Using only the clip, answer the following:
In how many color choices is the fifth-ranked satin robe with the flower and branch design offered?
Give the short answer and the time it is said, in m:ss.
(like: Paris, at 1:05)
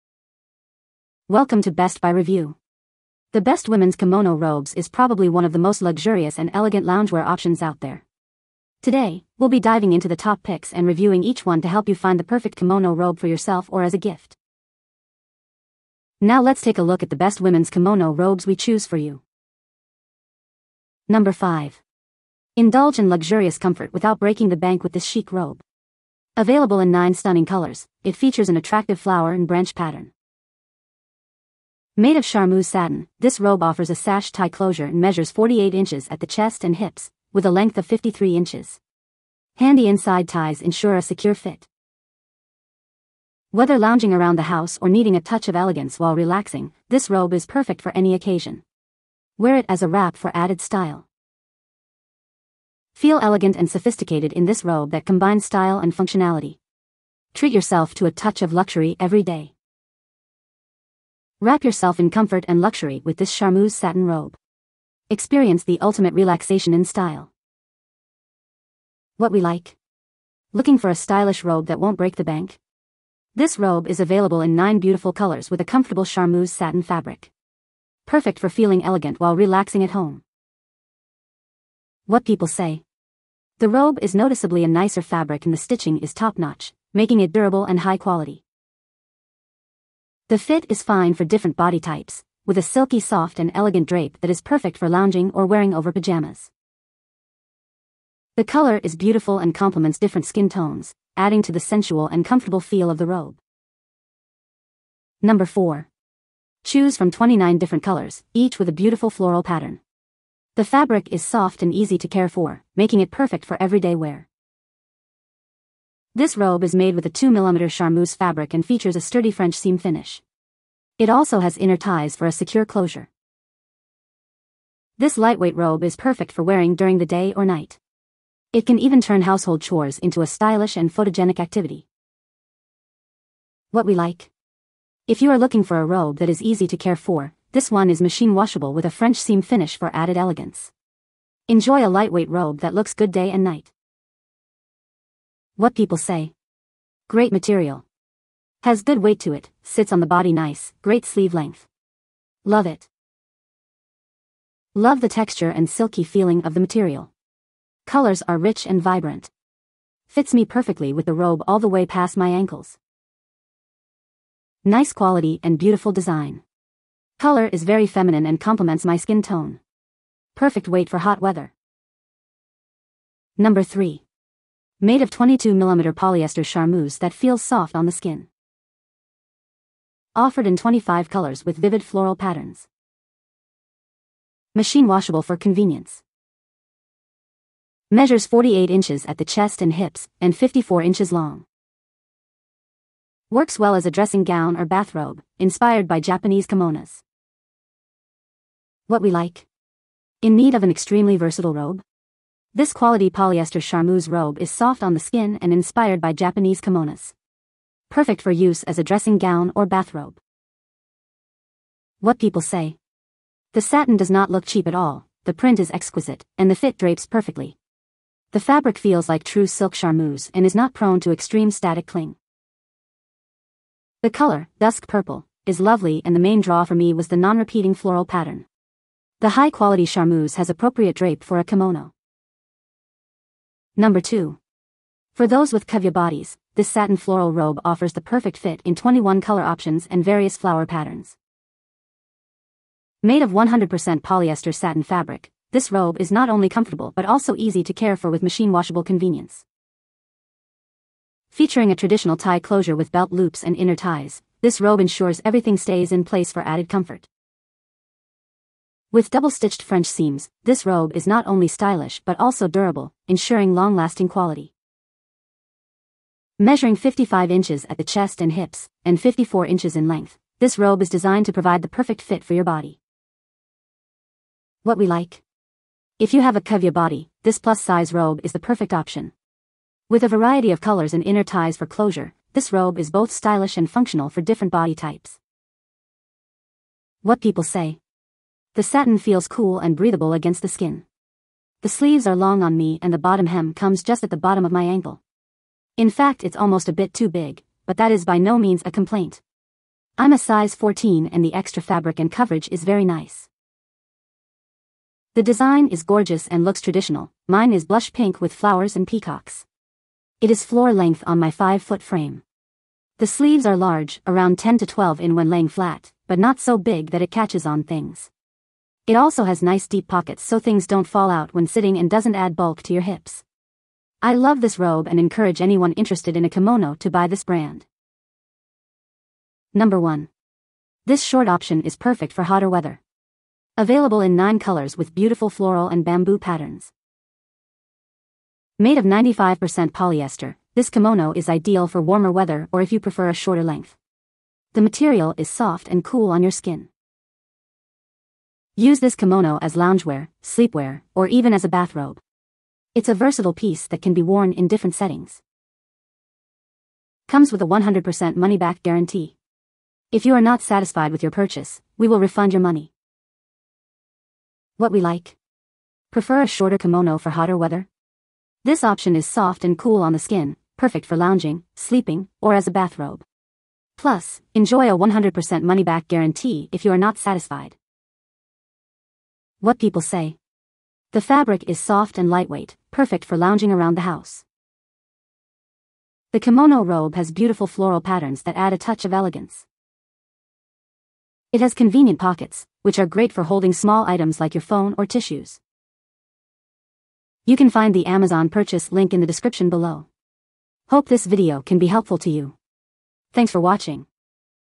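9, at 0:26.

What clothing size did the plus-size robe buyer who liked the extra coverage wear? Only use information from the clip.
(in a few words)
14.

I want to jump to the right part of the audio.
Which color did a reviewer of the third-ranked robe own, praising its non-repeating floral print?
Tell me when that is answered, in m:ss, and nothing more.
3:44.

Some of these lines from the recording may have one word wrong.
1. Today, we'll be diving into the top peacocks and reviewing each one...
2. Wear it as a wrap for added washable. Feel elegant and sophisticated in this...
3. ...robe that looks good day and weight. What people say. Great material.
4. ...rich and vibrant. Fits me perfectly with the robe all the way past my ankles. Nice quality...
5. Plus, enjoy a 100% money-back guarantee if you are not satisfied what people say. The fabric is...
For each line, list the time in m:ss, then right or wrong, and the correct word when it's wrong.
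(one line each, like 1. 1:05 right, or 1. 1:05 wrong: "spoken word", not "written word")
1. 0:08 wrong: "picks", not "peacocks"
2. 0:49 wrong: "style", not "washable"
3. 2:22 wrong: "night", not "weight"
4. 2:38 right
5. 6:13 right.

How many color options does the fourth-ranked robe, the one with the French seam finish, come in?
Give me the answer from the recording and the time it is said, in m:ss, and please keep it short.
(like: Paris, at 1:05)
29, at 1:47.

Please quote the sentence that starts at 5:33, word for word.
Available in 9 colors with beautiful floral and bamboo patterns.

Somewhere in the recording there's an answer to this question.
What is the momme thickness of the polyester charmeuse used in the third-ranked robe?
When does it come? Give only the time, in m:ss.
2:55.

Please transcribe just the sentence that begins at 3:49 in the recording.
The high-quality charmeuse has appropriate drape for a kimono.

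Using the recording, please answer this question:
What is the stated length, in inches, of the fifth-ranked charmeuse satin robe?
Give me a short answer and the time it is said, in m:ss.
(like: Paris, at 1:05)
53 inches, at 0:37.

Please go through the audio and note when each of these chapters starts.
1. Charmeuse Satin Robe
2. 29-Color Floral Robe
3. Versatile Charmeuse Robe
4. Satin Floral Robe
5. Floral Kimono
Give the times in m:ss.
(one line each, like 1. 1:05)
1. 0:19
2. 1:43
3. 2:52
4. 3:52
5. 5:28.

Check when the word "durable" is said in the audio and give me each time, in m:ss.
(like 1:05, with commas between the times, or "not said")
1:27, 4:22.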